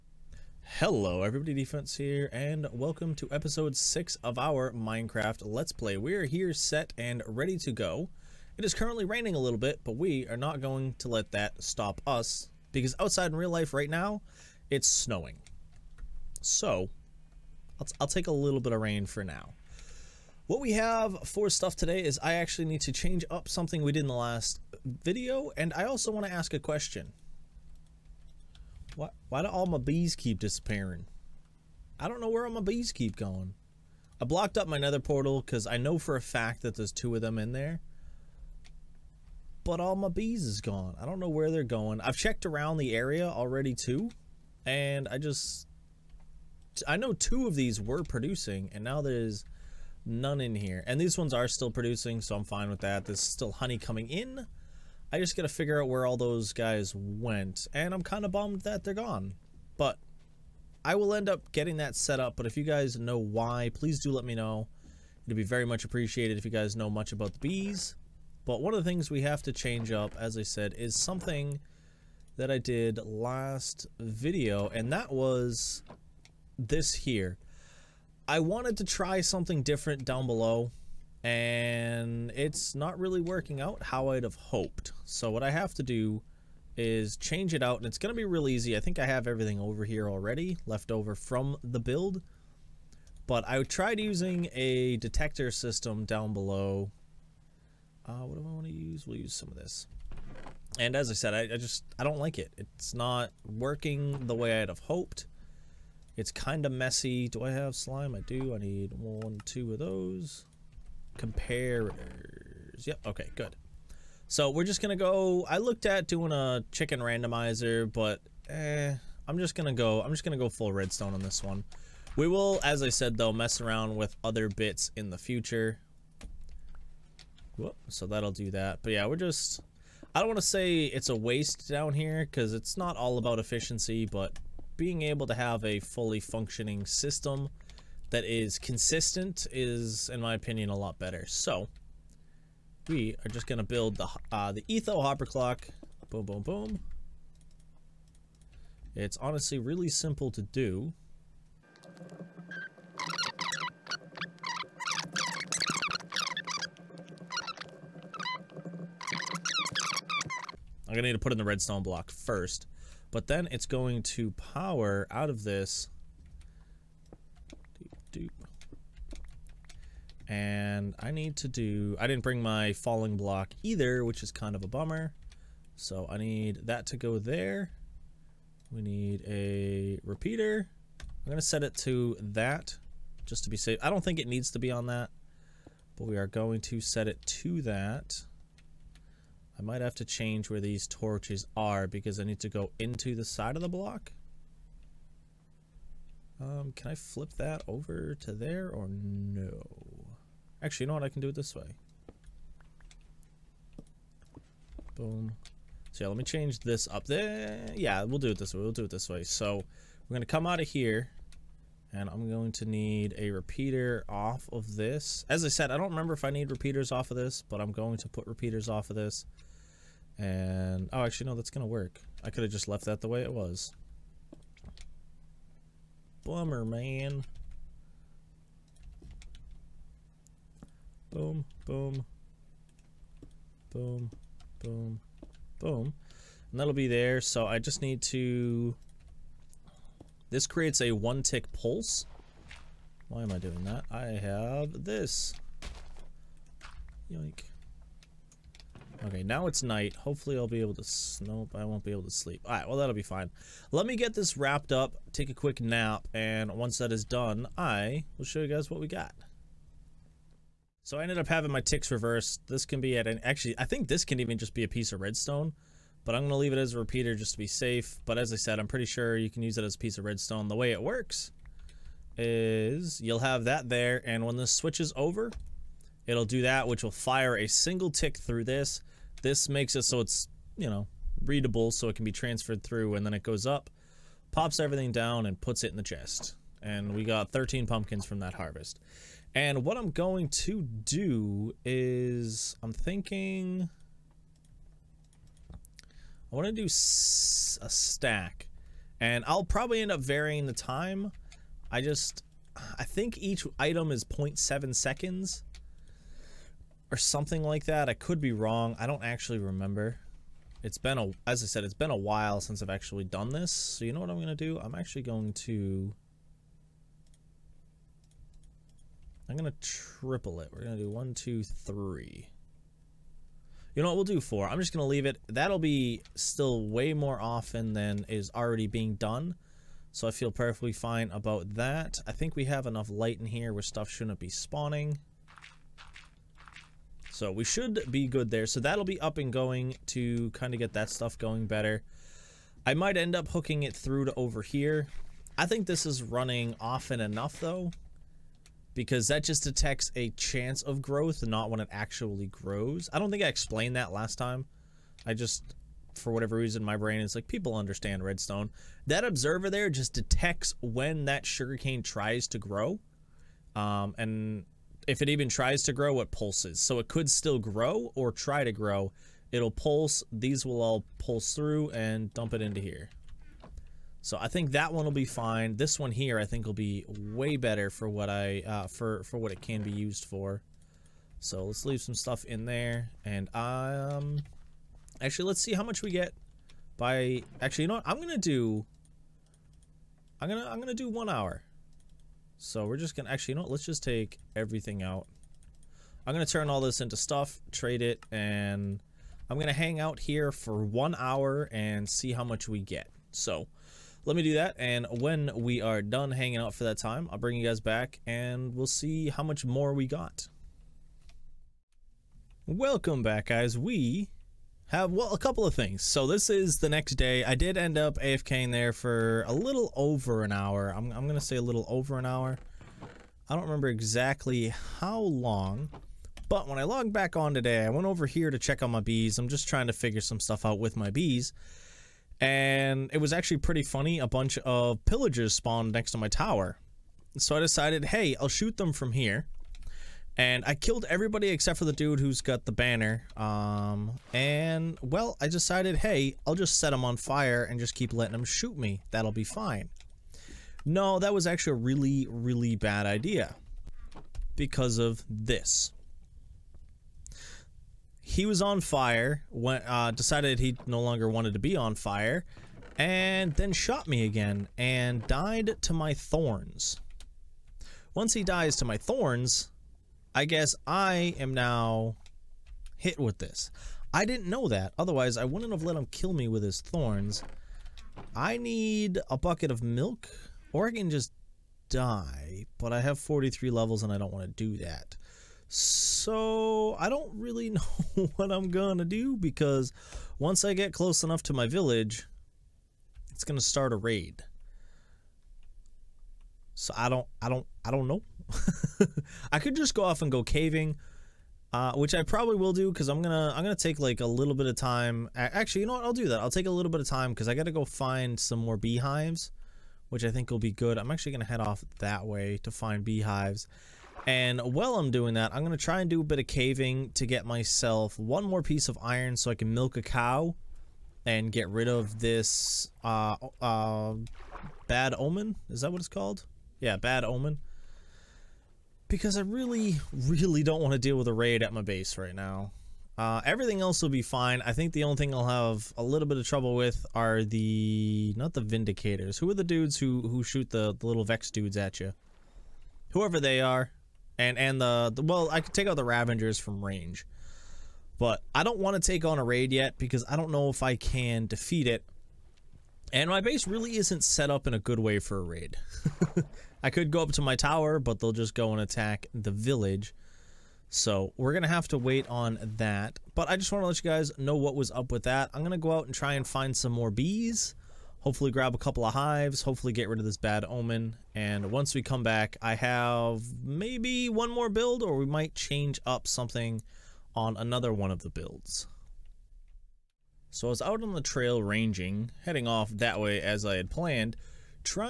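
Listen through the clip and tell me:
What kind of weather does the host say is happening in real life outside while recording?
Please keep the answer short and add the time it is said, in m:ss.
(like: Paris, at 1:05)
Snowing, at 0:14.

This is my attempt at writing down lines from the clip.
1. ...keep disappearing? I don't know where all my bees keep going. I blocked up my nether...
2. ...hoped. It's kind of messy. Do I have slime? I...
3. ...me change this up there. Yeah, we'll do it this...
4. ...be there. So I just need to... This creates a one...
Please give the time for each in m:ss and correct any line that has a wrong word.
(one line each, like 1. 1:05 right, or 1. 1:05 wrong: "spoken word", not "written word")
1. 0:30 right
2. 1:44 right
3. 3:26 right
4. 3:56 right.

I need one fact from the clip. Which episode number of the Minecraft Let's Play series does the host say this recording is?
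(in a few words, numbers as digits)
6.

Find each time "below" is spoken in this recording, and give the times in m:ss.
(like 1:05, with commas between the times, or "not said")
1:20, 1:36.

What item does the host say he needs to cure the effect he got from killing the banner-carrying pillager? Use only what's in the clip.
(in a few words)
Bucket of milk.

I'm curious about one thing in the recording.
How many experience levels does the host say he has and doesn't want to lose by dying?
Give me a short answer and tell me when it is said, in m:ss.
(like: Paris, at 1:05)
43, at 8:02.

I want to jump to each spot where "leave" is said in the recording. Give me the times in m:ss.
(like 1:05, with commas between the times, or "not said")
4:26, 5:24, 6:21.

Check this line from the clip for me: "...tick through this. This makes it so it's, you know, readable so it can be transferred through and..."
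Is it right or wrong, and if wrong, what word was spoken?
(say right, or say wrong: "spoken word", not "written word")
right.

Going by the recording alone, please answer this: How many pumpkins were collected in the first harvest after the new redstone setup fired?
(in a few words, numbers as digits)
13.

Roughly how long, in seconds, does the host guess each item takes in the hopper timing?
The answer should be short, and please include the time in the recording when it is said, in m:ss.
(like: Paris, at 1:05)
0.7 seconds, at 5:04.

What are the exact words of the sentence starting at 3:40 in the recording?
And, oh, actually, no, that's going to work.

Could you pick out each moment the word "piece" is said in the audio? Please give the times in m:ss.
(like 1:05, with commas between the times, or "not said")
4:24, 4:29, 8:38.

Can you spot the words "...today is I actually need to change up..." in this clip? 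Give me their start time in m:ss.
0:21.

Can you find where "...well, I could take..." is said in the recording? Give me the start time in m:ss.
9:05.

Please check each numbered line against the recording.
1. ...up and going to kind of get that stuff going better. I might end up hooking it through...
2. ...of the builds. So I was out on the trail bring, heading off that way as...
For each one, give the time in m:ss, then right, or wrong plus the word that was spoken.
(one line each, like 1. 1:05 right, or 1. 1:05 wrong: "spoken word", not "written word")
1. 5:39 right
2. 9:37 wrong: "ranging", not "bring".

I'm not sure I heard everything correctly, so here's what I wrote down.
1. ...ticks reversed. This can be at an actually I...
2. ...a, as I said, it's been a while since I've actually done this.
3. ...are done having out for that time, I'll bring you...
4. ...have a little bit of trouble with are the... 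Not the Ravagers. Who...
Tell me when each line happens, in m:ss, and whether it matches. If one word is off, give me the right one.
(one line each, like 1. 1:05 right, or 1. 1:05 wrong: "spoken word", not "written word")
1. 4:21 right
2. 5:10 right
3. 6:45 wrong: "hanging", not "having"
4. 8:55 wrong: "Vindicators", not "Ravagers".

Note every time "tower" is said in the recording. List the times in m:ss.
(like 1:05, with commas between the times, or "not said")
7:16, 9:17.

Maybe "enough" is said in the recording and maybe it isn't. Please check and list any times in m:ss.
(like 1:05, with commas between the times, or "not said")
5:32, 5:47, 8:11.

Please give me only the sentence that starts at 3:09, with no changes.
I might have to change where these torches are because I need to go into the side of the block.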